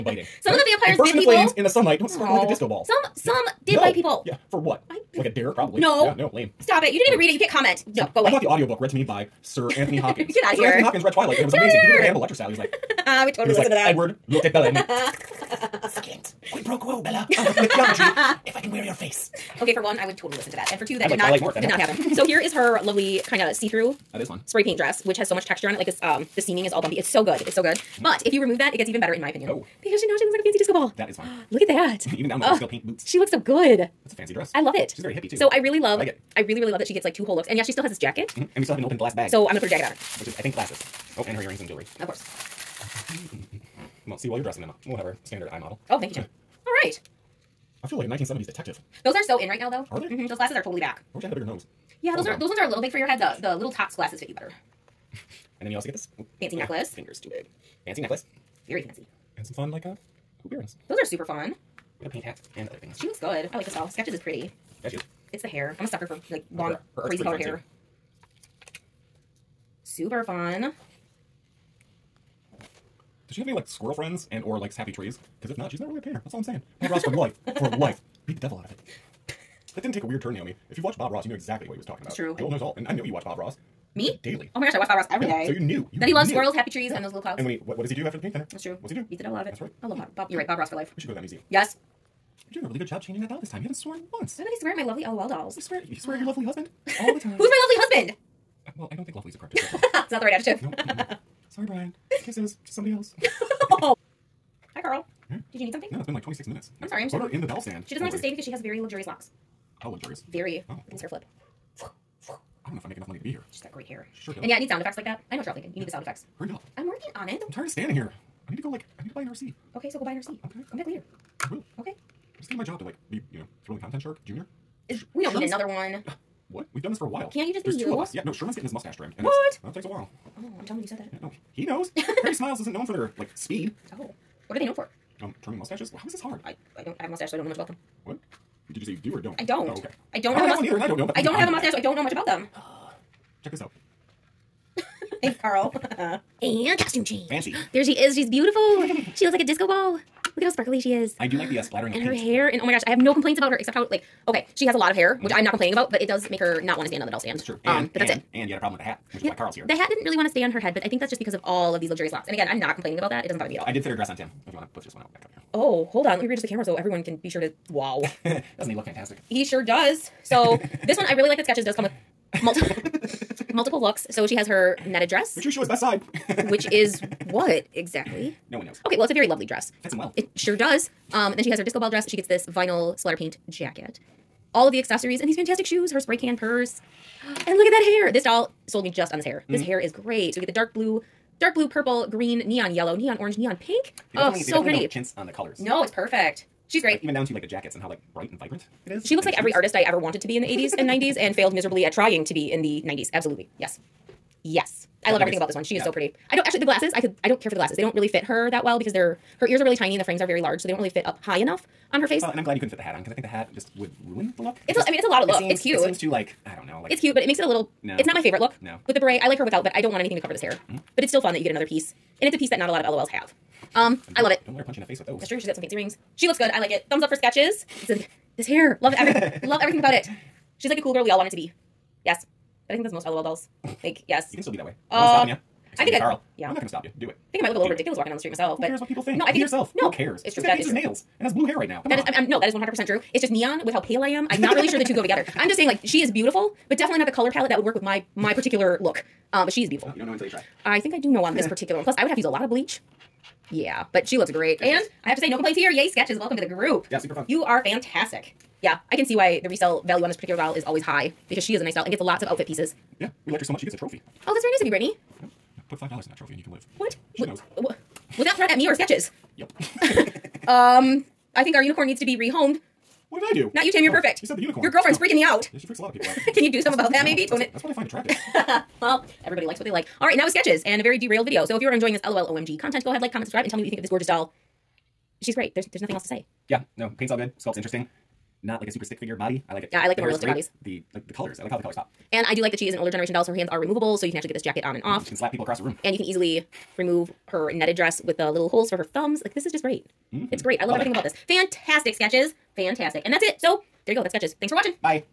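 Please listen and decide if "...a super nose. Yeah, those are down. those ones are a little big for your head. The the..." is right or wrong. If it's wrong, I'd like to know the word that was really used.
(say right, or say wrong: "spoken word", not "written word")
wrong: "bigger", not "super".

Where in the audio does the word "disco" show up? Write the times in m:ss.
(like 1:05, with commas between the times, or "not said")
0:02, 0:30, 2:29, 3:01.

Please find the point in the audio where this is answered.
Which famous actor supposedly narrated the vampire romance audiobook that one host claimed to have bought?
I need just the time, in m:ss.
0:10.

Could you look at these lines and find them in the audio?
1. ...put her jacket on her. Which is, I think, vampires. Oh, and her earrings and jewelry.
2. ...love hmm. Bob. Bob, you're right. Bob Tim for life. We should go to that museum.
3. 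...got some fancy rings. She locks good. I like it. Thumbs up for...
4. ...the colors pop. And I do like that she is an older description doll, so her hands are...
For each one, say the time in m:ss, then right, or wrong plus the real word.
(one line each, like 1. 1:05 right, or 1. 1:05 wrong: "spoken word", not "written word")
1. 0:39 wrong: "glasses", not "vampires"
2. 1:29 wrong: "Ross", not "Tim"
3. 3:45 wrong: "looks", not "locks"
4. 4:51 wrong: "generation", not "description".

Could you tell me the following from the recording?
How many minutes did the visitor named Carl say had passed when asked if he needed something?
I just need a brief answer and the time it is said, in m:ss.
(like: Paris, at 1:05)
26, at 1:46.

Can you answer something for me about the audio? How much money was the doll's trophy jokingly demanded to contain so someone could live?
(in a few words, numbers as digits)
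$5.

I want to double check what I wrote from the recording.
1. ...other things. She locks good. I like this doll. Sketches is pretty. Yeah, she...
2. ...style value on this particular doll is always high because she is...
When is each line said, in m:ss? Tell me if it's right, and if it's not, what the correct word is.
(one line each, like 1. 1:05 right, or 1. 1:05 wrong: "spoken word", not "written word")
1. 1:02 wrong: "looks", not "locks"
2. 4:19 wrong: "resale", not "style".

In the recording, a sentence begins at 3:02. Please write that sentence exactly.
She gets this vinyl splatter paint jacket all of the accessories and these fantastic shoes, her spray can purse.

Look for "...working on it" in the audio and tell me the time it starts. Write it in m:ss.
1:56.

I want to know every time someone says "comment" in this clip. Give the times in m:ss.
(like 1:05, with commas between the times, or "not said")
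0:07, 4:43.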